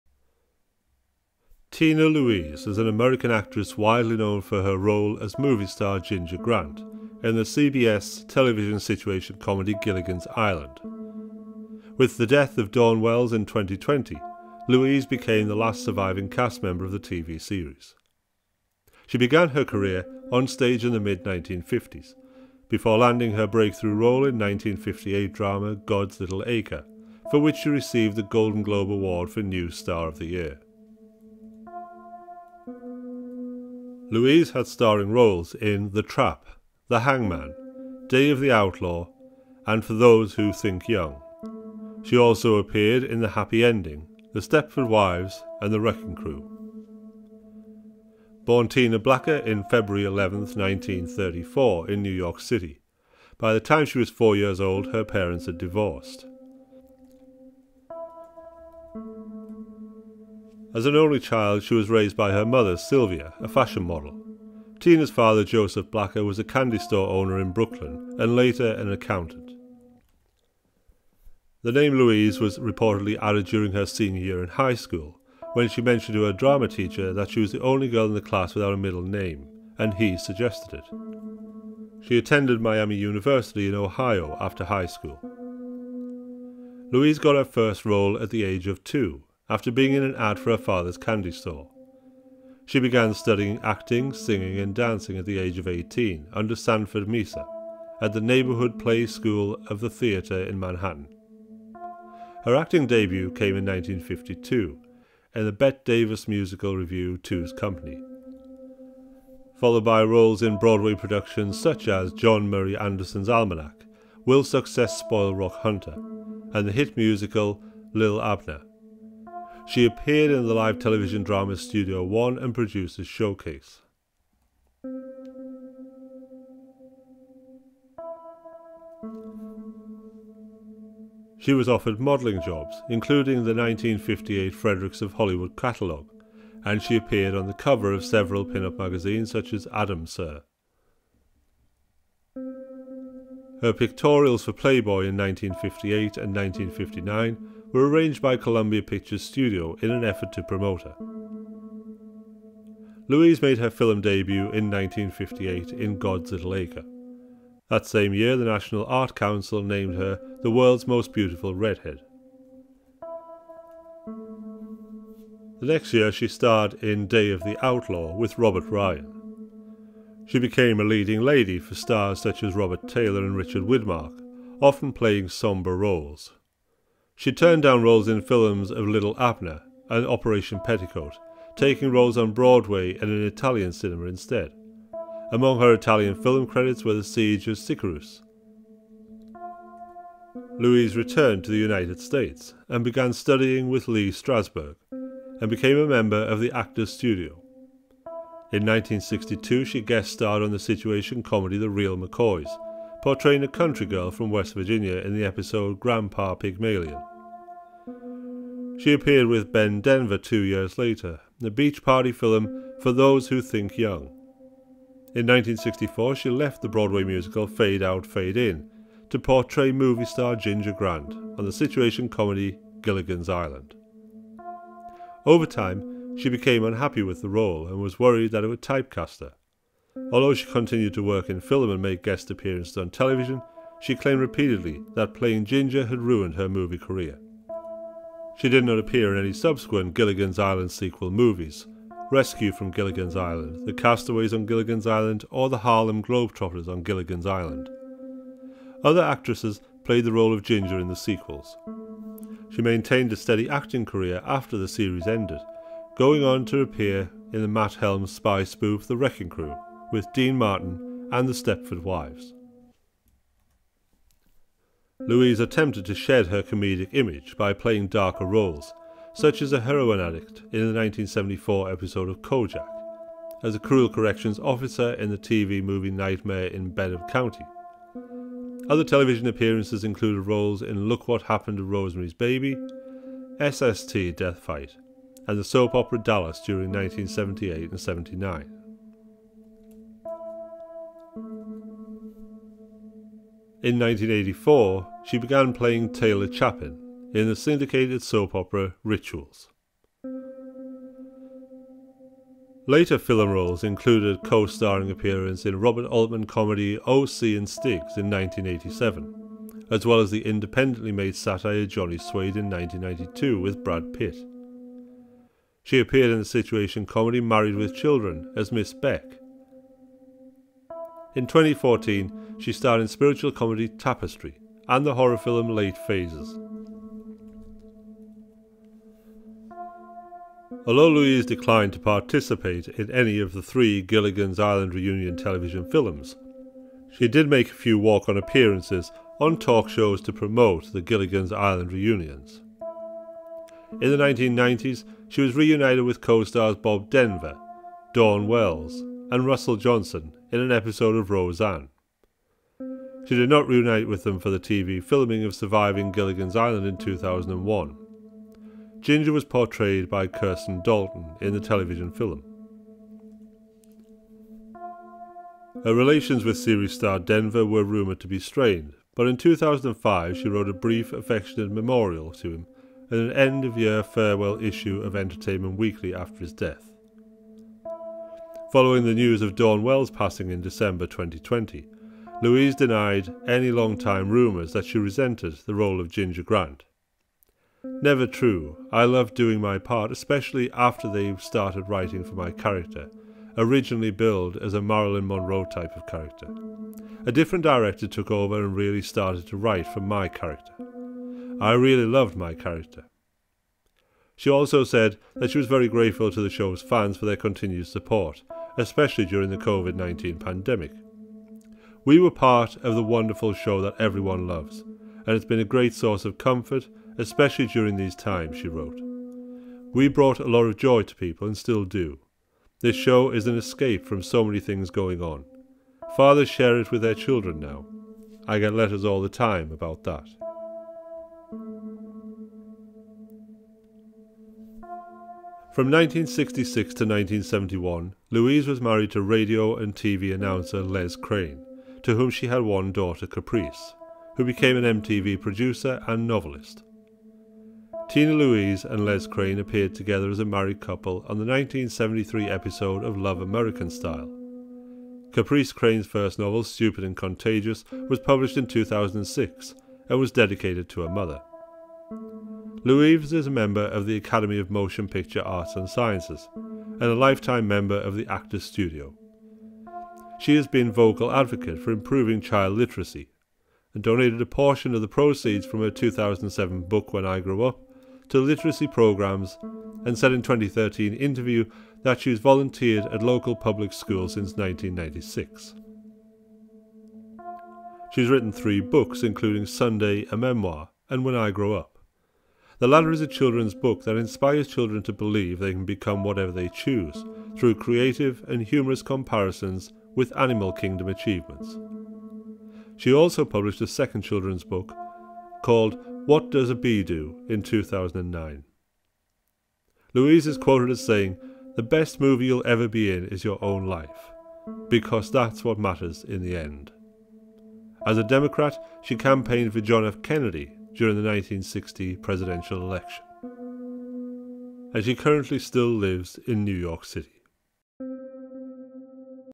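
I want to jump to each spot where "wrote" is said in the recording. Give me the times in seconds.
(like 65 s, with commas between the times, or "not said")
370 s, 418 s.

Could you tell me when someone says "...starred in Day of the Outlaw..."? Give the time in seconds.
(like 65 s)
166 s.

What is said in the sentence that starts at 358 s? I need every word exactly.
Ginger was portrayed by Kristen Dalton in the television film.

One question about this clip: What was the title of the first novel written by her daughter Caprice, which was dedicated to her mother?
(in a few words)
Stupid and Contagious.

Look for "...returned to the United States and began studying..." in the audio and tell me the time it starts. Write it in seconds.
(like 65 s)
190 s.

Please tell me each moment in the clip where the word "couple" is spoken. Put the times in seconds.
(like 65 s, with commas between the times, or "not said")
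450 s.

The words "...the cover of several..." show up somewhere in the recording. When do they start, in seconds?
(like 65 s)
137 s.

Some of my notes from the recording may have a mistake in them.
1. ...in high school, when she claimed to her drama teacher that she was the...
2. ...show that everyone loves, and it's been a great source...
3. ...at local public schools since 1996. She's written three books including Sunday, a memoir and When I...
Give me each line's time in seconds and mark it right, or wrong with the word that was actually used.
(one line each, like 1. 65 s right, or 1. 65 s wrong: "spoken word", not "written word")
1. 74 s wrong: "mentioned", not "claimed"
2. 413 s right
3. 482 s right.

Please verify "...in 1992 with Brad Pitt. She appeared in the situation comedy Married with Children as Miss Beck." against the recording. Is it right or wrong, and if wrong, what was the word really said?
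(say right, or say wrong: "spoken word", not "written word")
right.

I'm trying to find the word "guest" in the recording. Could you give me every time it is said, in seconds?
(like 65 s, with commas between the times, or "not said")
199 s, 232 s.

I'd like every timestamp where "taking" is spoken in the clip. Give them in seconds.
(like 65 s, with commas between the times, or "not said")
181 s.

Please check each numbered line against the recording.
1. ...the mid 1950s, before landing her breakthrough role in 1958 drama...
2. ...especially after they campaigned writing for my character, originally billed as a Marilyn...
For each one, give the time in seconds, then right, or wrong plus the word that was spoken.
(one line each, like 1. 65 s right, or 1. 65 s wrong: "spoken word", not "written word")
1. 20 s right
2. 389 s wrong: "started", not "campaigned".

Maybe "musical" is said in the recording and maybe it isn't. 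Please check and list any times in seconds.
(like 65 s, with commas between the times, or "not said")
106 s, 116 s, 217 s.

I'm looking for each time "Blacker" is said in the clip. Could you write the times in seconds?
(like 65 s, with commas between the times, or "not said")
48 s, 65 s.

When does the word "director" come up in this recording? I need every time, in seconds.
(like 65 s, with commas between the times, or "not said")
397 s.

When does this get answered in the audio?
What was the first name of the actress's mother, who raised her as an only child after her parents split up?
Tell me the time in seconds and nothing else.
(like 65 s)
62 s.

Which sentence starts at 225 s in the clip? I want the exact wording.
Over time, she became unhappy with the role and was worried that it would typecast her.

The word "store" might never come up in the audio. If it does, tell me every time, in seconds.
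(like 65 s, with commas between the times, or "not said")
66 s, 91 s.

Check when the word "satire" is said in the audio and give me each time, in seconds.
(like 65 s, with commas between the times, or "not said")
311 s.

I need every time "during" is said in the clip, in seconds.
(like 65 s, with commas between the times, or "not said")
73 s, 286 s, 409 s, 417 s, 520 s.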